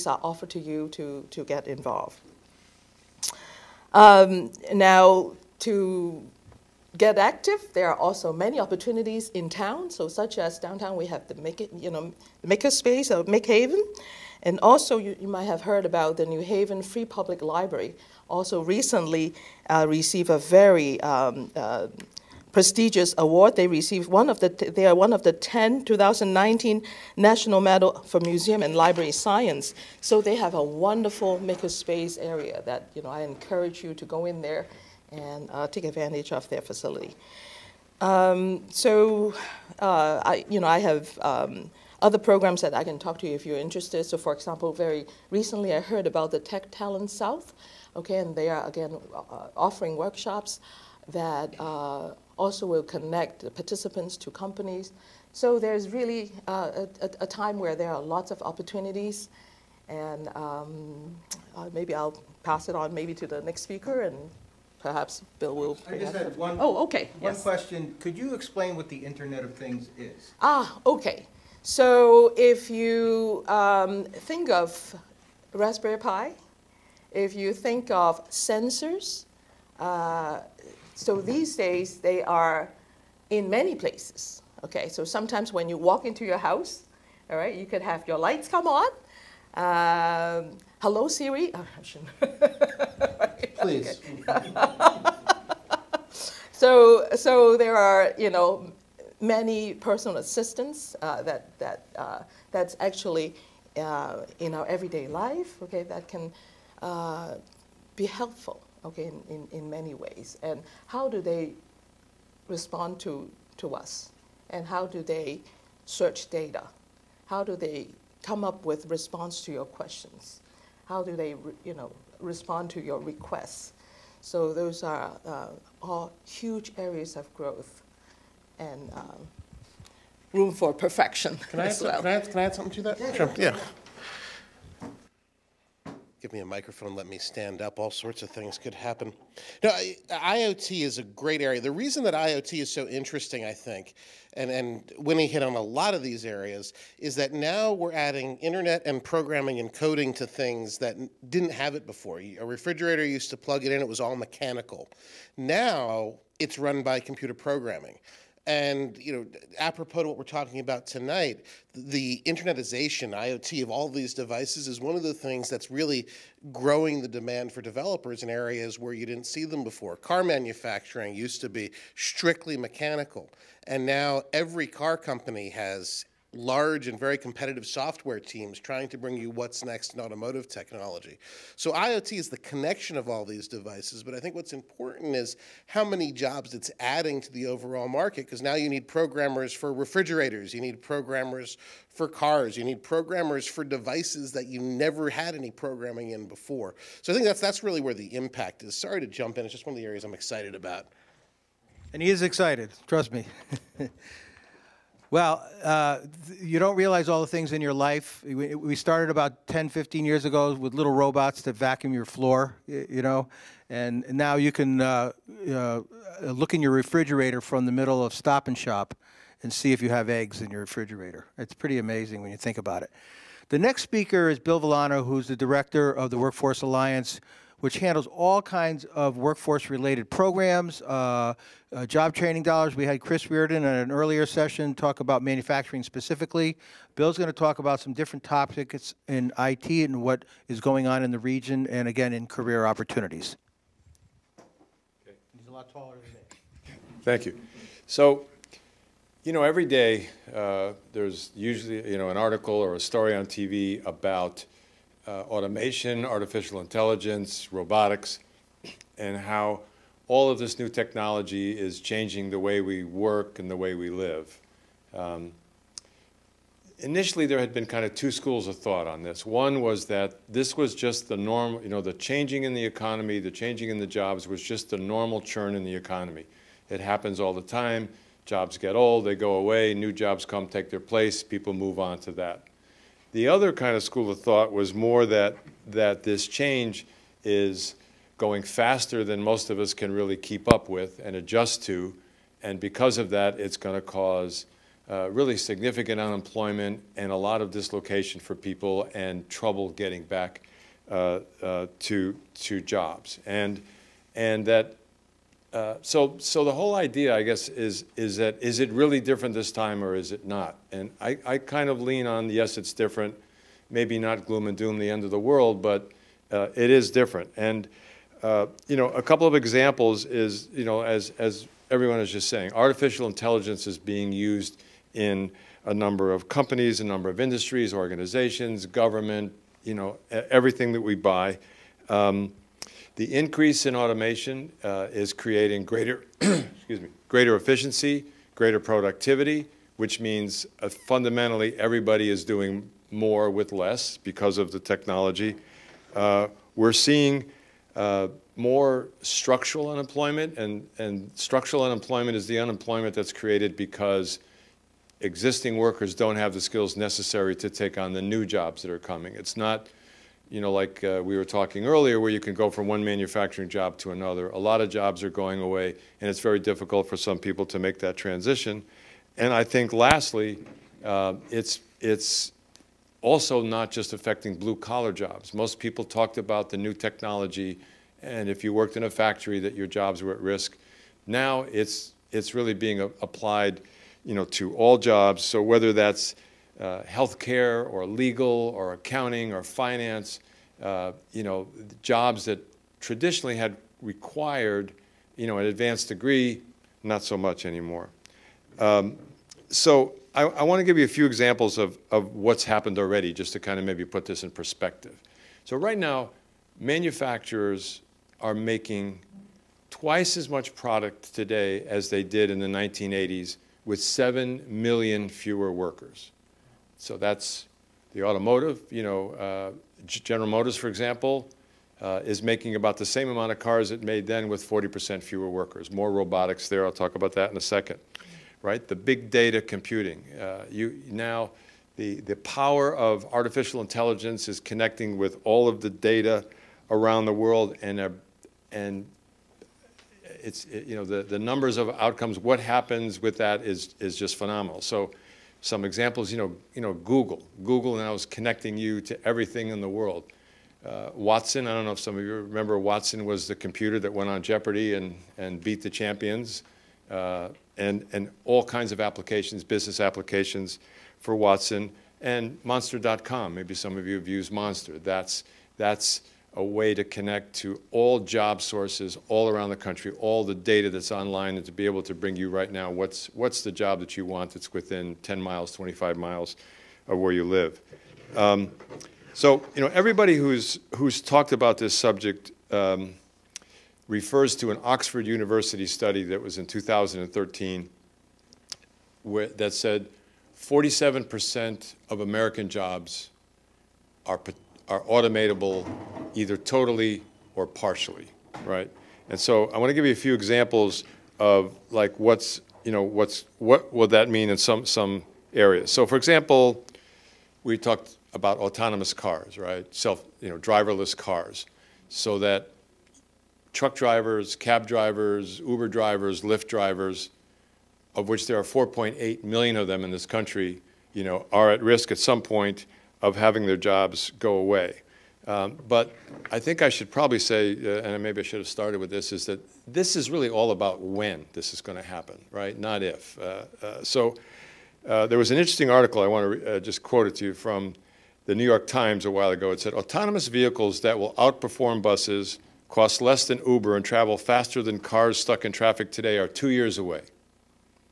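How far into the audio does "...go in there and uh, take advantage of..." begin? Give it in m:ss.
0:34.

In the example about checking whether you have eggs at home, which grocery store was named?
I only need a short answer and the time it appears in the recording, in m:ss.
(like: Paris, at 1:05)
Stop and Shop, at 3:38.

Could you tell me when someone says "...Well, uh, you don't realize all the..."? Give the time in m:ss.
3:25.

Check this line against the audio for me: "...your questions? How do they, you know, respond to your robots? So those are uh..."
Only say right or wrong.
wrong.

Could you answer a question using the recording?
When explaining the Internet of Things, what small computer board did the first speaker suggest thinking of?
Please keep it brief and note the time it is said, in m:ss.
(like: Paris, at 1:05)
Raspberry Pi, at 1:15.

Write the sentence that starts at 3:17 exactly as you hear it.
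So I think that's, that's really where the impact is.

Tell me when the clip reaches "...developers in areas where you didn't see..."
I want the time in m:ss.
2:47.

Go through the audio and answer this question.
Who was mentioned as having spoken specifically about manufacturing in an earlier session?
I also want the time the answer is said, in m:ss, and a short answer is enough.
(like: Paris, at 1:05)
Chris Reardon, at 3:53.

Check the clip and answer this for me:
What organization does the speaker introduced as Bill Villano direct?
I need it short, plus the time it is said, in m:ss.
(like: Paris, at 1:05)
Workforce Alliance, at 3:46.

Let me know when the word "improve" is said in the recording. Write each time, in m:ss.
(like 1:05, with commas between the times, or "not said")
not said.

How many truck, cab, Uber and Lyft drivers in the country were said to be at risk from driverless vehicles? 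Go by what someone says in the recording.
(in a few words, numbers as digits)
4.8 million.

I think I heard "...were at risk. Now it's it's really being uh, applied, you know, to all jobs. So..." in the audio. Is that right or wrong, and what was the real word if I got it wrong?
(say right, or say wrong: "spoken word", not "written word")
right.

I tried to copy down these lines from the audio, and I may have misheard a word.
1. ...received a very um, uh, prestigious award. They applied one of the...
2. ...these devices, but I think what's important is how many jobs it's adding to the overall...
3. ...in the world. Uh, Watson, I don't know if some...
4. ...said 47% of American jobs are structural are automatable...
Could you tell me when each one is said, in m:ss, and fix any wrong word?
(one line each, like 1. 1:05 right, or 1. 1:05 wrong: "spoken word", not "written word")
1. 0:19 wrong: "received", not "applied"
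2. 3:03 right
3. 7:29 right
4. 8:09 wrong: "potential", not "structural".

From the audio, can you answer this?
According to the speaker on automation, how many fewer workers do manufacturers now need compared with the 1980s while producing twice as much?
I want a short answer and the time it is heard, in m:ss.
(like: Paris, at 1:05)
7 million, at 6:53.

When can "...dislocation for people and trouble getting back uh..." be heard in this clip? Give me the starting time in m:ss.
4:57.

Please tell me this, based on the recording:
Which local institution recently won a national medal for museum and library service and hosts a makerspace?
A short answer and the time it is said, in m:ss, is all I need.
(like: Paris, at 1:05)
New Haven Free Public Library, at 0:16.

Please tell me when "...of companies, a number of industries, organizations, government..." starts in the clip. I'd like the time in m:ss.
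5:26.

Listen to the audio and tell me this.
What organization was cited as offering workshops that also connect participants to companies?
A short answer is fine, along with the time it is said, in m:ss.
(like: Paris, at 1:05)
Tech Talent South, at 0:46.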